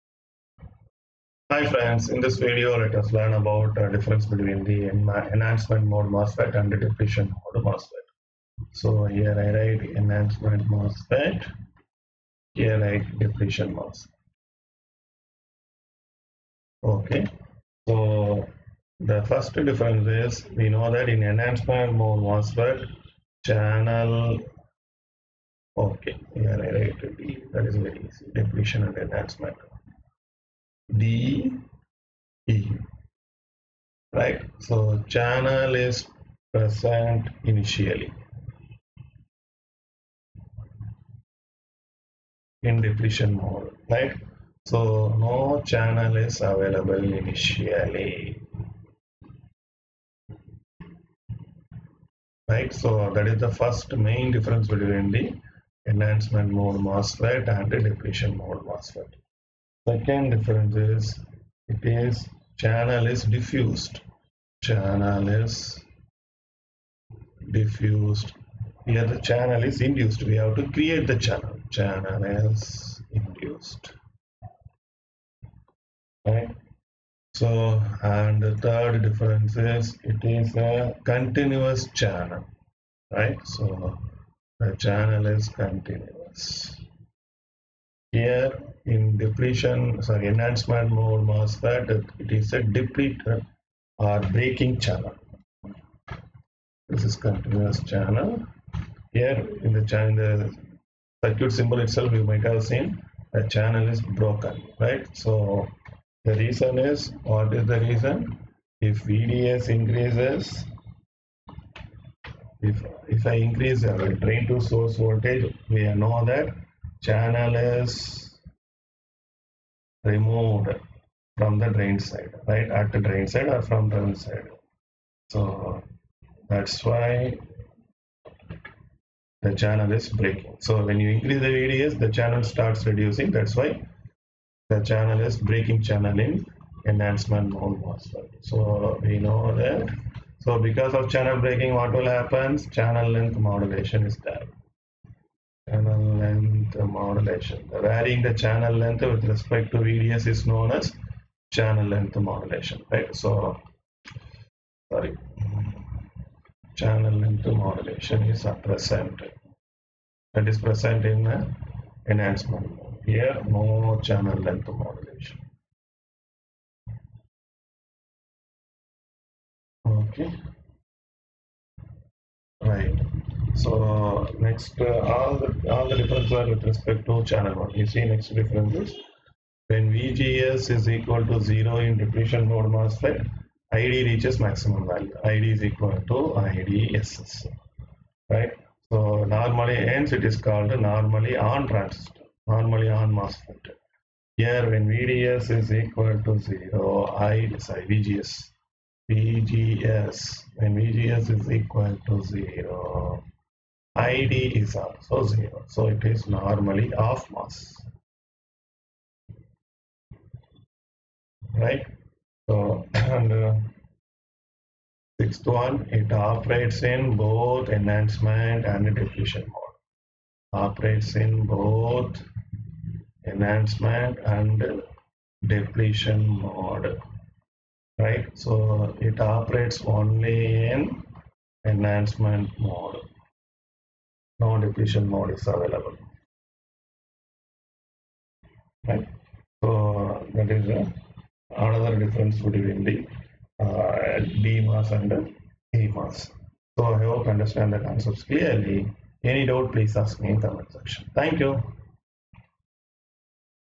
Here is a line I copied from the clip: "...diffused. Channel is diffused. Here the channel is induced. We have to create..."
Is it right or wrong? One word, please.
right.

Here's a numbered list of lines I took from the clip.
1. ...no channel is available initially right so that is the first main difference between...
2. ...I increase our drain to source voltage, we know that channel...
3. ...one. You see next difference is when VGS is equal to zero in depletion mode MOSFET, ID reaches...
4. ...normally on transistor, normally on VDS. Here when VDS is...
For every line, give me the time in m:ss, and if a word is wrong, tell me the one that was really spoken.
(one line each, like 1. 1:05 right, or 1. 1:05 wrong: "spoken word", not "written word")
1. 0:45 right
2. 1:53 right
3. 2:57 right
4. 3:10 wrong: "MOSFET", not "VDS".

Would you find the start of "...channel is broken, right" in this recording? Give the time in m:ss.
1:43.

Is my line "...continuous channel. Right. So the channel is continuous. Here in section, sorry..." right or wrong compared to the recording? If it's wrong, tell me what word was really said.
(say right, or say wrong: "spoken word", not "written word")
wrong: "depletion", not "section".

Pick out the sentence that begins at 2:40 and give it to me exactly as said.
That is present in the enhancement.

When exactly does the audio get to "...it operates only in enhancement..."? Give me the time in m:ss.
3:49.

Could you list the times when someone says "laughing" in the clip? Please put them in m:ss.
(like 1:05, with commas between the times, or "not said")
not said.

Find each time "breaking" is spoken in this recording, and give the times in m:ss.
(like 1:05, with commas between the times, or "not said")
1:34, 2:10, 2:15, 2:21.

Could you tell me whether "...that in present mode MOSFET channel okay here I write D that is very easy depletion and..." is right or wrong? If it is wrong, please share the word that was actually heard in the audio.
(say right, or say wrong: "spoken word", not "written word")
wrong: "enhancement", not "present".